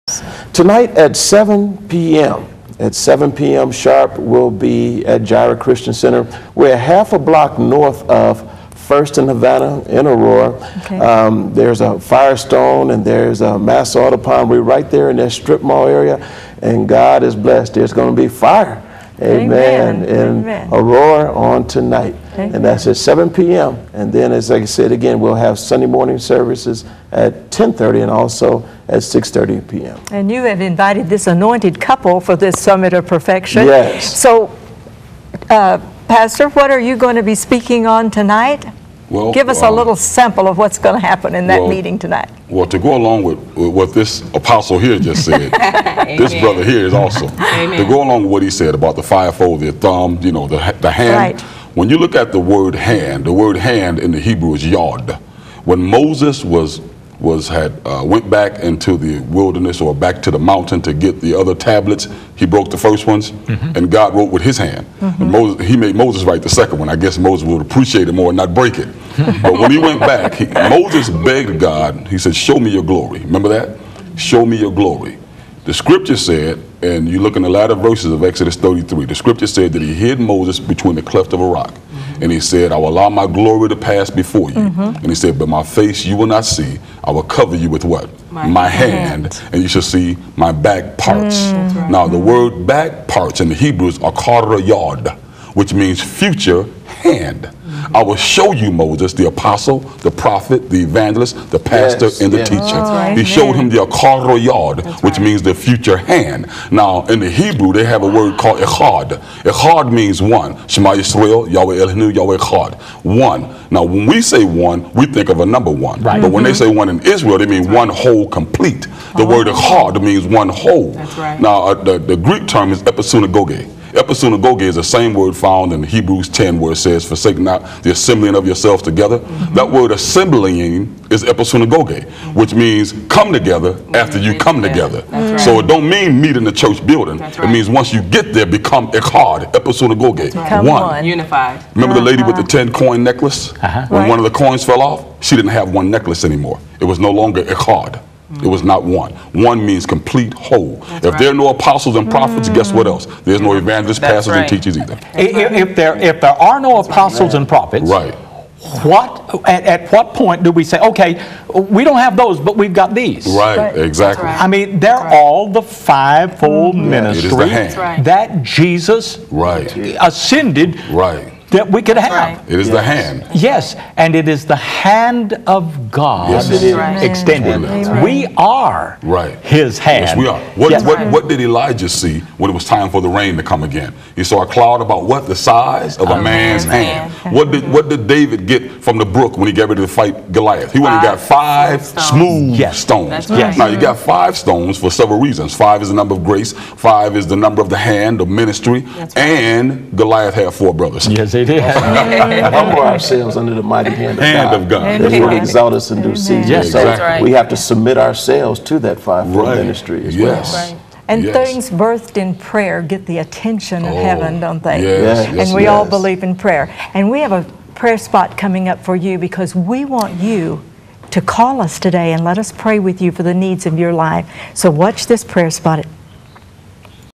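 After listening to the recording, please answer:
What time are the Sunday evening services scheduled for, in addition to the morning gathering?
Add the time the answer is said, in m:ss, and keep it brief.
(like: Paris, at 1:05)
6:30 p.m., at 0:29.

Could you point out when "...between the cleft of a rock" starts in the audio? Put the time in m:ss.
1:20.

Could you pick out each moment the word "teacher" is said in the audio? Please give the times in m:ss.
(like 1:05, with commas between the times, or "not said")
1:42, 2:34.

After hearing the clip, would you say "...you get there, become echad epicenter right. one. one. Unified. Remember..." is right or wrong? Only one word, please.
right.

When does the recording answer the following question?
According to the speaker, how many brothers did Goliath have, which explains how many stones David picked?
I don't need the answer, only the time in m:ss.
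3:20.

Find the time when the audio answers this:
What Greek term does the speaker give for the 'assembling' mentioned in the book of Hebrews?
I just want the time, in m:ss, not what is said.
2:02.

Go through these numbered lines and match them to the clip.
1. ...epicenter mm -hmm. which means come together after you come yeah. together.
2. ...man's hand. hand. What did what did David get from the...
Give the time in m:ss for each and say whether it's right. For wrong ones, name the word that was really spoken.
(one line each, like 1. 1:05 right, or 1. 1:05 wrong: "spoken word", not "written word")
1. 2:11 right
2. 3:06 right.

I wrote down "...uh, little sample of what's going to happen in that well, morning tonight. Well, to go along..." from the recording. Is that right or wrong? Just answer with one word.
wrong.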